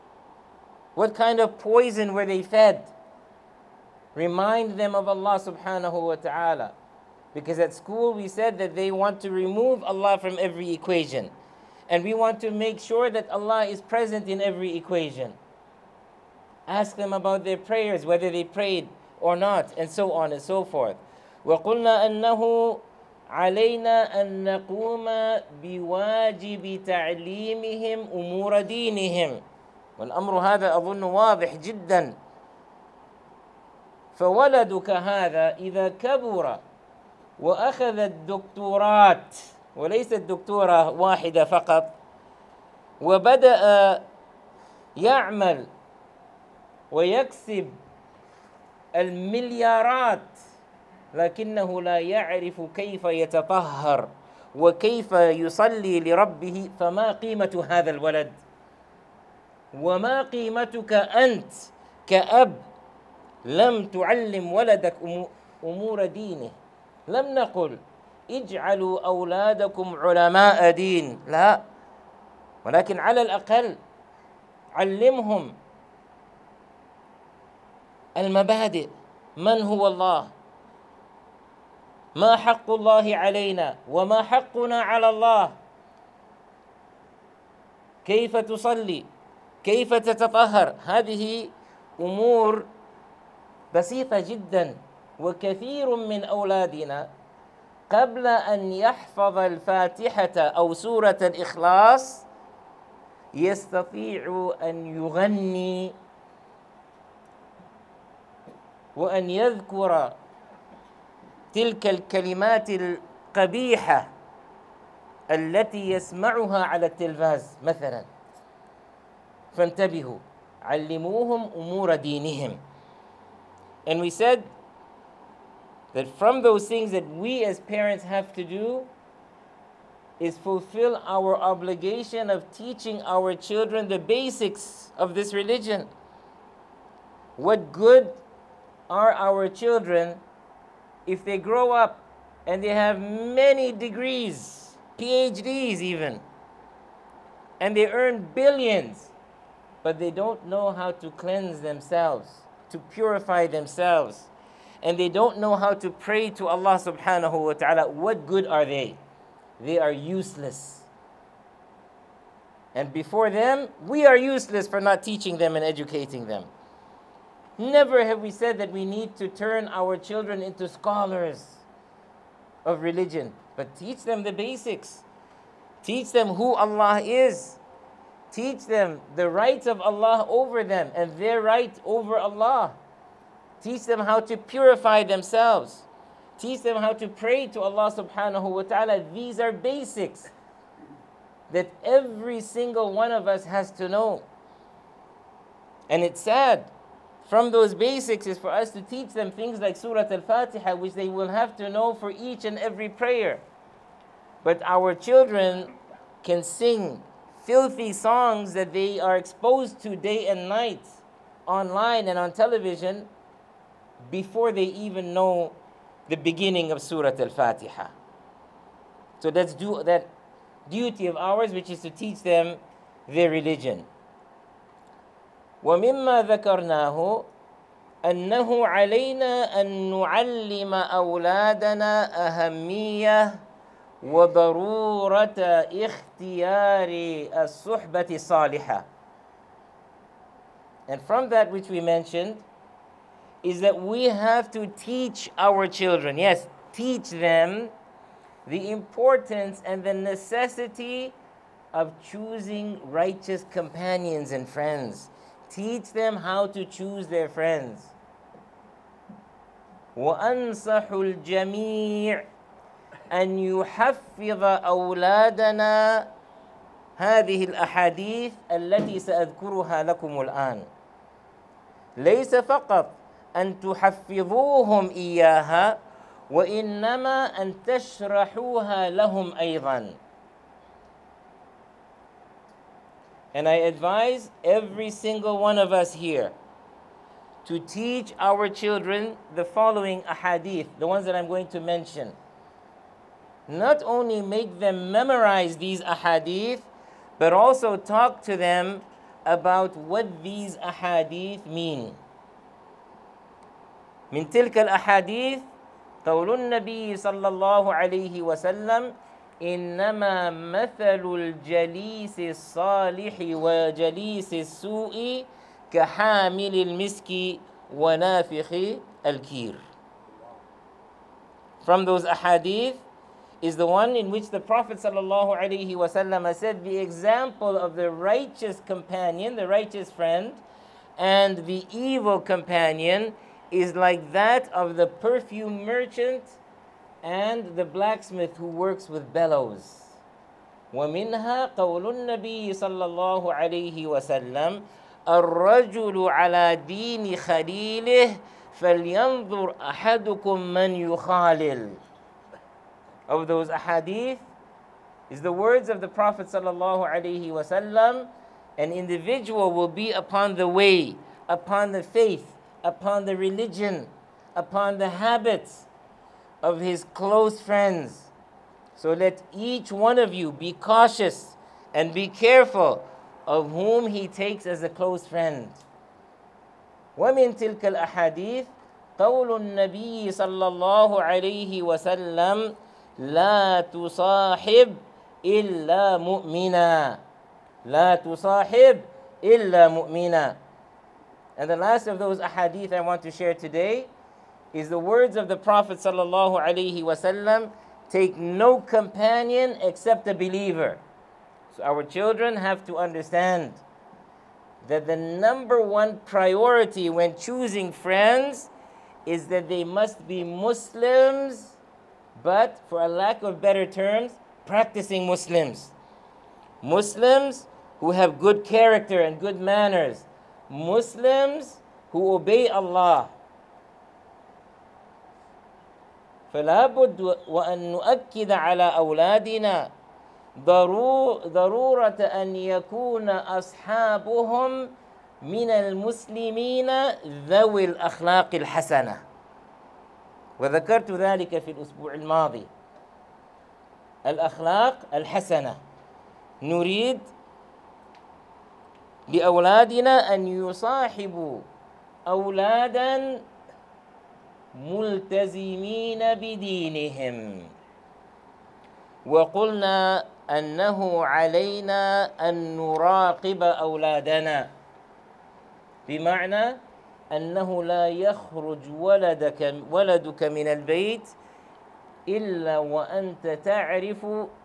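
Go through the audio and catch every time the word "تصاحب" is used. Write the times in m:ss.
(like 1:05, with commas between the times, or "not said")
6:23, 6:27.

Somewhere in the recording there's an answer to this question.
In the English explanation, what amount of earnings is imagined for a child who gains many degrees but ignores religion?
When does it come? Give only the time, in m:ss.
2:27.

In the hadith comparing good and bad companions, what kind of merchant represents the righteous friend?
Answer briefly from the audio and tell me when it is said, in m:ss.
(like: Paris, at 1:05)
perfume merchant, at 5:34.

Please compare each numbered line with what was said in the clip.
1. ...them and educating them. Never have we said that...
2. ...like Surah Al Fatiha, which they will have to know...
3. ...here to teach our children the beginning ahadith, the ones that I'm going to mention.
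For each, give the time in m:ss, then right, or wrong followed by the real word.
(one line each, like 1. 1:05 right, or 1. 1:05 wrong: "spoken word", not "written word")
1. 2:45 right
2. 3:19 right
3. 4:45 wrong: "following", not "beginning".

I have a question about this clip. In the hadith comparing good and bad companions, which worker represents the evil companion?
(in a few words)
the blacksmith.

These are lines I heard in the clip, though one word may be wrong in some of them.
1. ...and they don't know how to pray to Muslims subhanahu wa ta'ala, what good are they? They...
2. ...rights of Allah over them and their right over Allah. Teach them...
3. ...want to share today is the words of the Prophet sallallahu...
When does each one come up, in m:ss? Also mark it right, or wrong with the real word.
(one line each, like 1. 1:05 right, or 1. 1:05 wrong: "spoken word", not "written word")
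1. 2:34 wrong: "Allah", not "Muslims"
2. 2:59 right
3. 6:32 right.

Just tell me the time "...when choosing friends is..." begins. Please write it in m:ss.
6:46.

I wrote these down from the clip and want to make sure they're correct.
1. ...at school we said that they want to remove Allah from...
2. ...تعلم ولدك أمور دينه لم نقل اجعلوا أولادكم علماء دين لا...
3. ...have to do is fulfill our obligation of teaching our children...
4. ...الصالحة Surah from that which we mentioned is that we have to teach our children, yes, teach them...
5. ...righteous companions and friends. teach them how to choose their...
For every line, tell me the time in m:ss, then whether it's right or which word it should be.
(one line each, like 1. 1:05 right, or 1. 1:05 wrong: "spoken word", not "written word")
1. 0:07 right
2. 1:03 right
3. 2:08 right
4. 3:58 wrong: "And", not "Surah"
5. 4:12 right.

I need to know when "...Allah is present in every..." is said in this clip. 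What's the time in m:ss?
0:13.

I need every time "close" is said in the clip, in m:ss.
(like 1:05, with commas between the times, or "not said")
6:06, 6:14.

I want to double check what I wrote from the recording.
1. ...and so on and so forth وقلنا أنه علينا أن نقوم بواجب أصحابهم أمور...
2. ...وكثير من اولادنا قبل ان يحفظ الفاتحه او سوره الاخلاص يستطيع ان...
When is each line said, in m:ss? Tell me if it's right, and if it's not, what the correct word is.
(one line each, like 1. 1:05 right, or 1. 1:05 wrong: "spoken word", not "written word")
1. 0:19 wrong: "تعليمهم", not "أصحابهم"
2. 1:35 right.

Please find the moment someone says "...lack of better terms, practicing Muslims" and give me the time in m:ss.
6:52.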